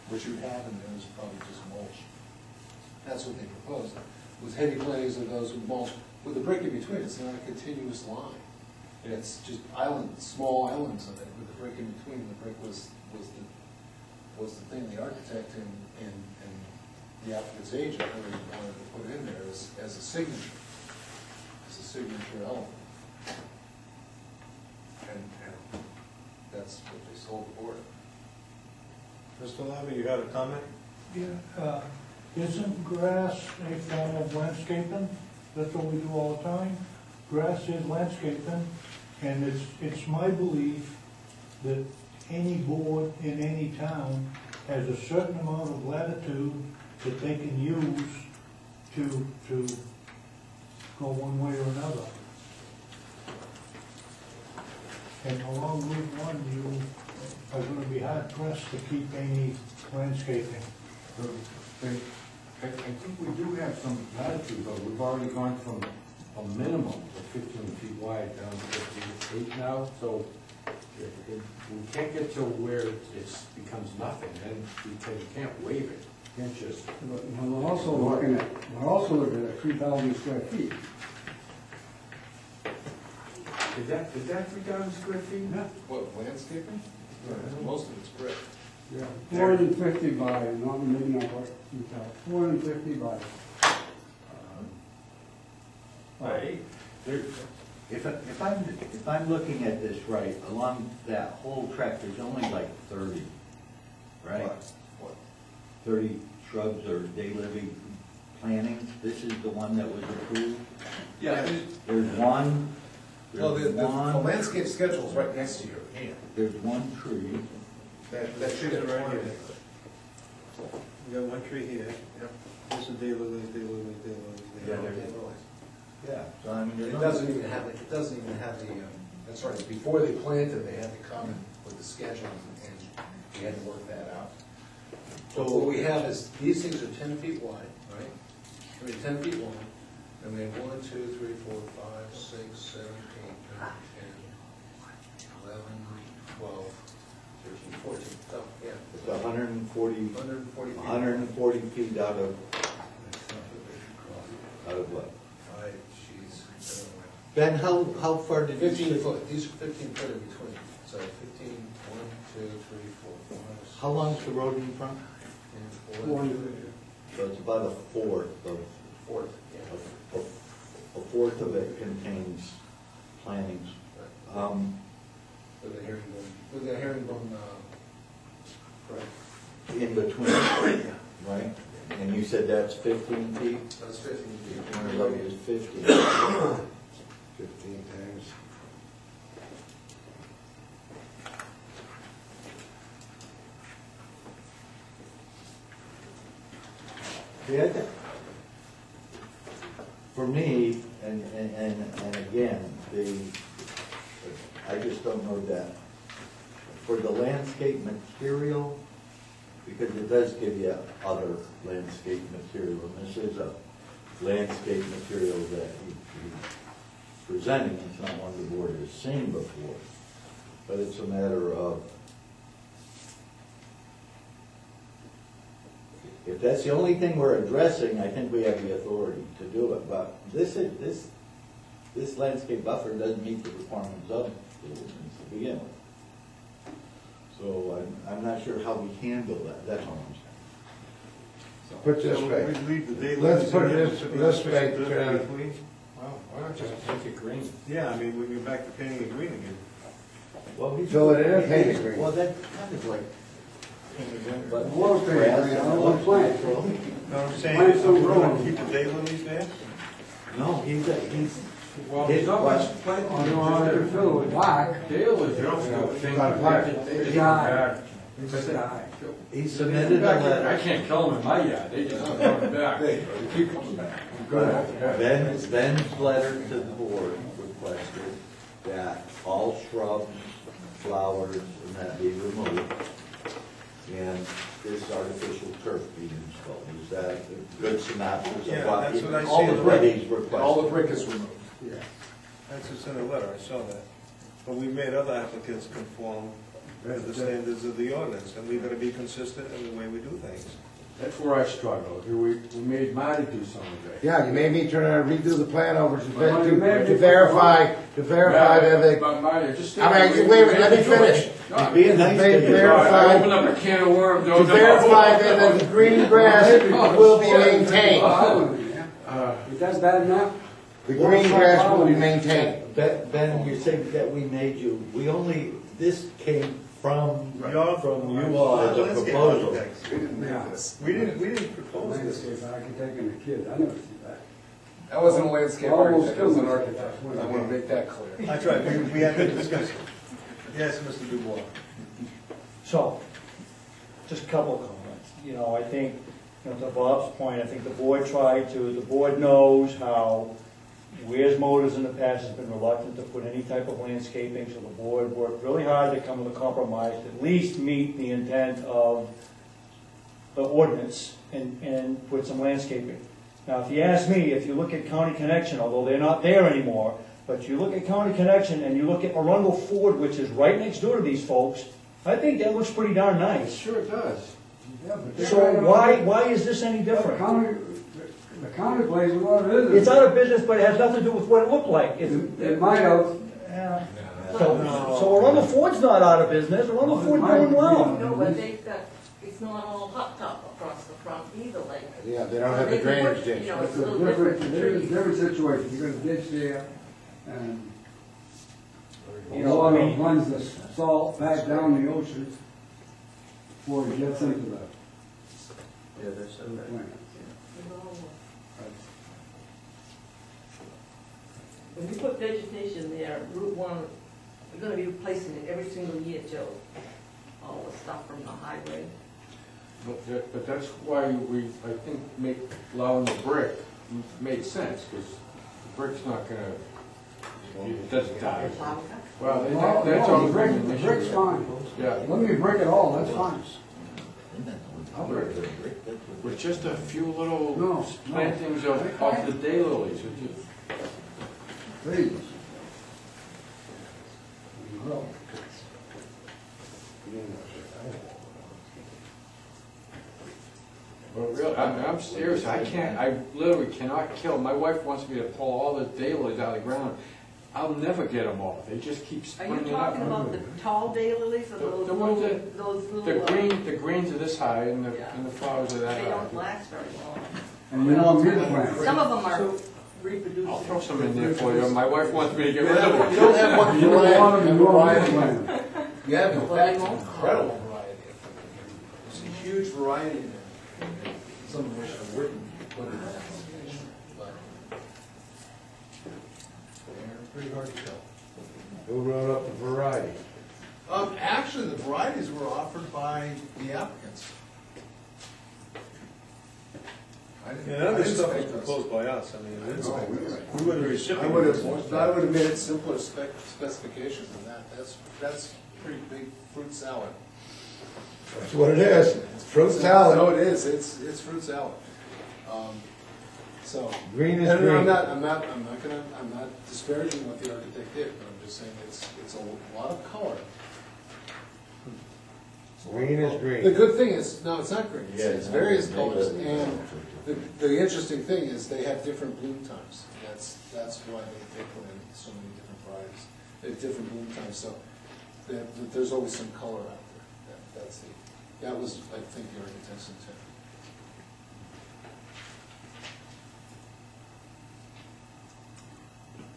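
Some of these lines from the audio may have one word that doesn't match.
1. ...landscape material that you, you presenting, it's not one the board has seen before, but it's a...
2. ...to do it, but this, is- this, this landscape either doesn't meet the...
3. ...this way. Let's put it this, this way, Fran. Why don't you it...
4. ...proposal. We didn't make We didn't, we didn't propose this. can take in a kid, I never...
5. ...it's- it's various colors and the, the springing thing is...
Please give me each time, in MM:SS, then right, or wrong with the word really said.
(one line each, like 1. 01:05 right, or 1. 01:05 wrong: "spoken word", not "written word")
1. 03:34 right
2. 03:49 wrong: "buffer", not "either"
3. 04:02 right
4. 05:29 right
5. 08:45 wrong: "interesting", not "springing".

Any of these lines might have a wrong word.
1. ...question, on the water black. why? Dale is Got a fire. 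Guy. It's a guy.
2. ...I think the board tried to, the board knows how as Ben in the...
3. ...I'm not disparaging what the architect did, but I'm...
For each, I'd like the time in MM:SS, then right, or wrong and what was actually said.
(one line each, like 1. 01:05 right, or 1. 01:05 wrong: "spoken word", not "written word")
1. 04:22 right
2. 05:47 wrong: "Motors", not "Ben"
3. 08:36 right.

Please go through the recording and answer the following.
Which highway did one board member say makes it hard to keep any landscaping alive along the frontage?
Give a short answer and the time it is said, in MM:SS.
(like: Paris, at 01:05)
Route One, at 00:55.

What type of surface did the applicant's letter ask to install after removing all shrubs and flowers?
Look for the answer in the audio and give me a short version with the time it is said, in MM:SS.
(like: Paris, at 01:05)
Artificial turf, at 04:44.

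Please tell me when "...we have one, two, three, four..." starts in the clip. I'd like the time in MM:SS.
02:20.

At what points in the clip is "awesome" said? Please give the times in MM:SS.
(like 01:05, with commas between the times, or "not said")
not said.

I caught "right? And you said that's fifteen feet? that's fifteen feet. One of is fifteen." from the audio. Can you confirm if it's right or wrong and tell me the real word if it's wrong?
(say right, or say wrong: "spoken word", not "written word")
right.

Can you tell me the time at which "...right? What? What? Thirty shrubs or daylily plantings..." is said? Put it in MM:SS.
01:44.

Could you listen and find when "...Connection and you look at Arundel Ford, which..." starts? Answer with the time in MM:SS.
06:08.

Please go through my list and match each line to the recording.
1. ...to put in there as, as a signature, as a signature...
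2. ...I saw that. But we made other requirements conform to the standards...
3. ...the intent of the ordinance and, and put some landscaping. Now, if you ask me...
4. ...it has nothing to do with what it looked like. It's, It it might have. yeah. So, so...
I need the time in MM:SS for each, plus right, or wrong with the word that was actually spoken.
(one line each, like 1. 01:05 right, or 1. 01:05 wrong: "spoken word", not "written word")
1. 00:18 right
2. 04:53 wrong: "applicants", not "requirements"
3. 05:57 right
4. 06:20 right.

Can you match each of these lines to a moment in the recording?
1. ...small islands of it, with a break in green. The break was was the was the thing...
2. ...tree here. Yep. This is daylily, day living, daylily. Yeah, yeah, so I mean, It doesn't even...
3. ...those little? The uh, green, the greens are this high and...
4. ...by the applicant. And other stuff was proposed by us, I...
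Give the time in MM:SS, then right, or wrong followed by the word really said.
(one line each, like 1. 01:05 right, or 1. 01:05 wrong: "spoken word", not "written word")
1. 00:10 wrong: "between", not "green"
2. 02:01 right
3. 07:42 right
4. 08:12 right.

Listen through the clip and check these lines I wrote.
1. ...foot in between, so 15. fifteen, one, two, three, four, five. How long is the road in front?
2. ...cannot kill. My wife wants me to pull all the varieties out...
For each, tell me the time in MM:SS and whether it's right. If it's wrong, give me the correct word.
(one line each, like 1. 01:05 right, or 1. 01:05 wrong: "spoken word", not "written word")
1. 02:39 right
2. 07:33 wrong: "daylilies", not "varieties".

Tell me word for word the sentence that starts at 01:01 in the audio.
So, I I think we do have some latitude, though.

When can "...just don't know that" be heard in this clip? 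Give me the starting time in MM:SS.
03:24.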